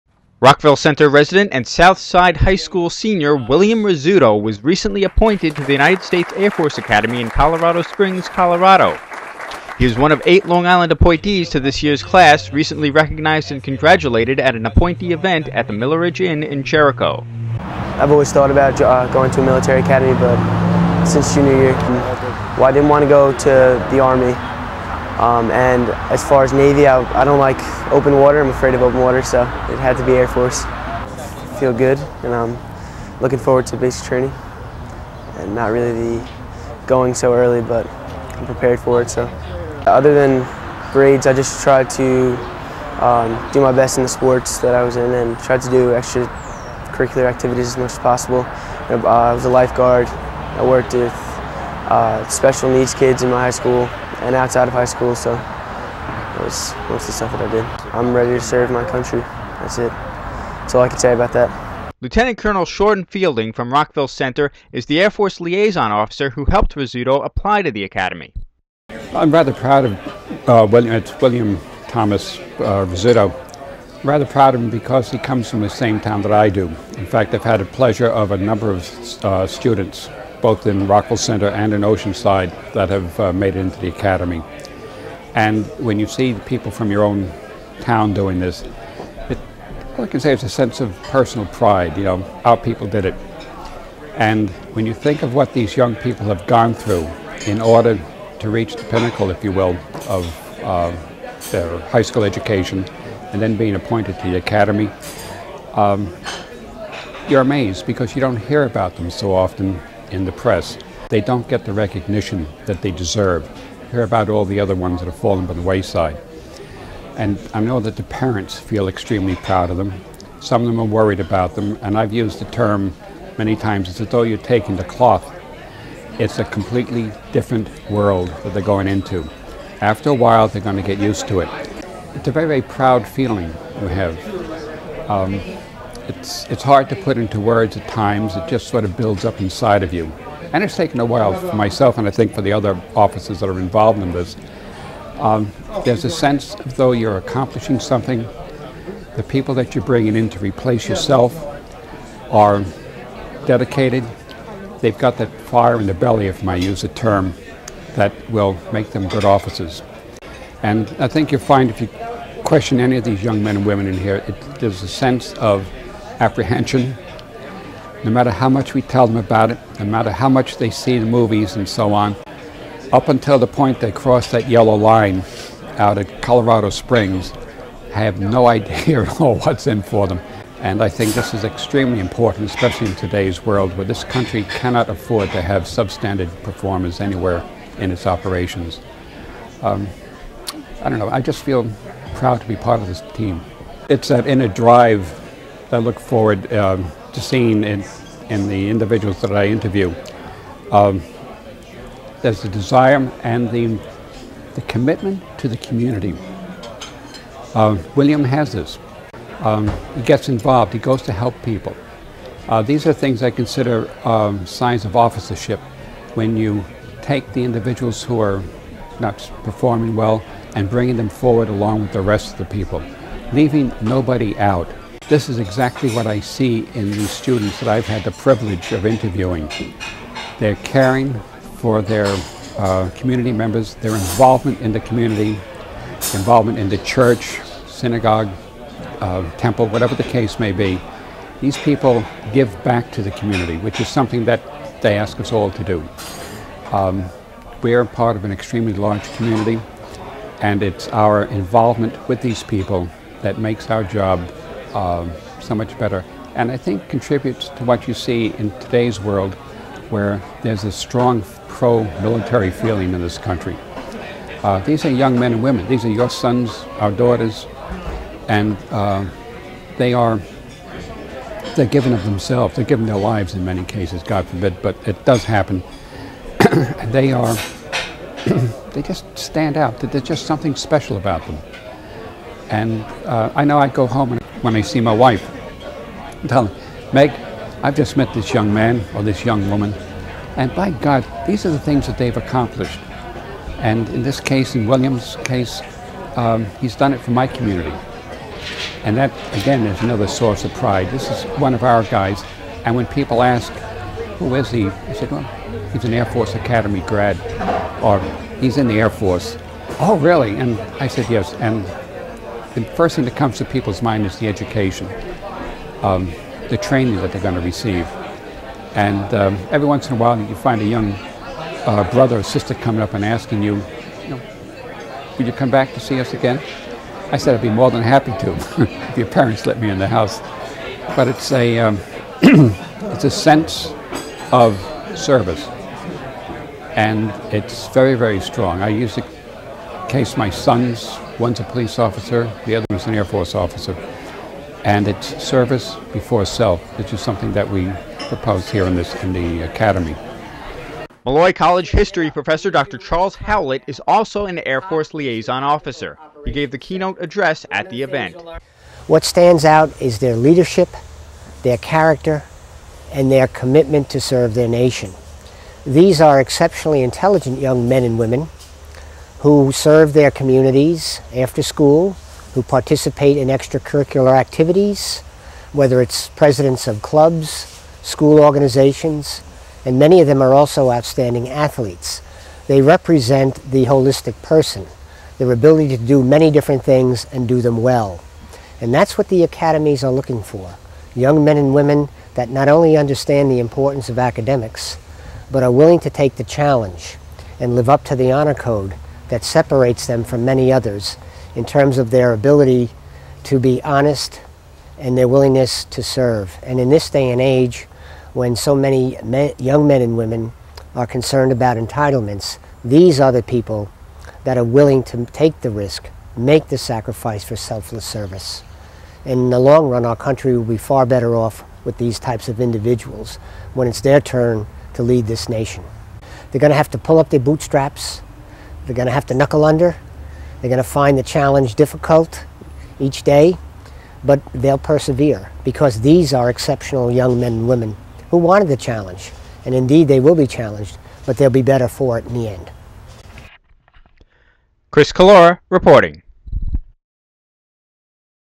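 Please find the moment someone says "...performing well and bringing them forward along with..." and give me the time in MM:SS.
03:39.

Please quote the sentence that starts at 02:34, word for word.
They've got that fire in the belly, if I use a term, that will make them good officers.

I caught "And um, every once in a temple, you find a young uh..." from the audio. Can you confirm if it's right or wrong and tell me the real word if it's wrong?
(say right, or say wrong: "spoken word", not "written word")
wrong: "while", not "temple".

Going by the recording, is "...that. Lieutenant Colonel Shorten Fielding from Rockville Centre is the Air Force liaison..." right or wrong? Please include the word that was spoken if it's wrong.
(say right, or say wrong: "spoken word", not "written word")
right.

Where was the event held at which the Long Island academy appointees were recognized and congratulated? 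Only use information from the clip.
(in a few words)
Milleridge Inn.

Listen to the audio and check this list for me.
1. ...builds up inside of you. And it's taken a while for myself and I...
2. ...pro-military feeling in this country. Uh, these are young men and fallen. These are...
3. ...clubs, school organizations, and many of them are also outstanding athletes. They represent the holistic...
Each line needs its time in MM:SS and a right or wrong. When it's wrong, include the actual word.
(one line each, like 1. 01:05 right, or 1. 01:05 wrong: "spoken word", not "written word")
1. 02:18 right
2. 04:21 wrong: "women", not "fallen"
3. 06:16 right.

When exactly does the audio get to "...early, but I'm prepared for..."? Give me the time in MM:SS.
00:37.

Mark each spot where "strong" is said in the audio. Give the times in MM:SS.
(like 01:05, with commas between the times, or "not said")
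04:20, 05:38.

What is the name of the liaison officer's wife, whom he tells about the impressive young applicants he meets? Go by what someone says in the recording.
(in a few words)
Meg.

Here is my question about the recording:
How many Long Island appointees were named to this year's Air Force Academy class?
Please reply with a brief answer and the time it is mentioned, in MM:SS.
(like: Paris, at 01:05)
8, at 00:10.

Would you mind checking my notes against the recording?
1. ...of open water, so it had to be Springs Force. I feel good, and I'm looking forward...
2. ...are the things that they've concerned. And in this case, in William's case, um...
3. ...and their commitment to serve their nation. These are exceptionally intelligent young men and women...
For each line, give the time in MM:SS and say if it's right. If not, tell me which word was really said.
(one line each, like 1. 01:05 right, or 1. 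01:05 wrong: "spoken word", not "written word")
1. 00:28 wrong: "Air", not "Springs"
2. 04:51 wrong: "accomplished", not "concerned"
3. 06:02 right.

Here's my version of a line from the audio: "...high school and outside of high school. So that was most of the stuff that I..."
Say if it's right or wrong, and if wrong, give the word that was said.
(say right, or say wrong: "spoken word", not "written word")
right.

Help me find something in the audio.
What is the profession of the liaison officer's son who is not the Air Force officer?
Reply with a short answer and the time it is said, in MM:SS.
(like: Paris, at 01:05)
Police officer, at 05:41.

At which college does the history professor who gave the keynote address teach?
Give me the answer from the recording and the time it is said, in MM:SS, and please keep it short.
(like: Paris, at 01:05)
Molloy College, at 05:51.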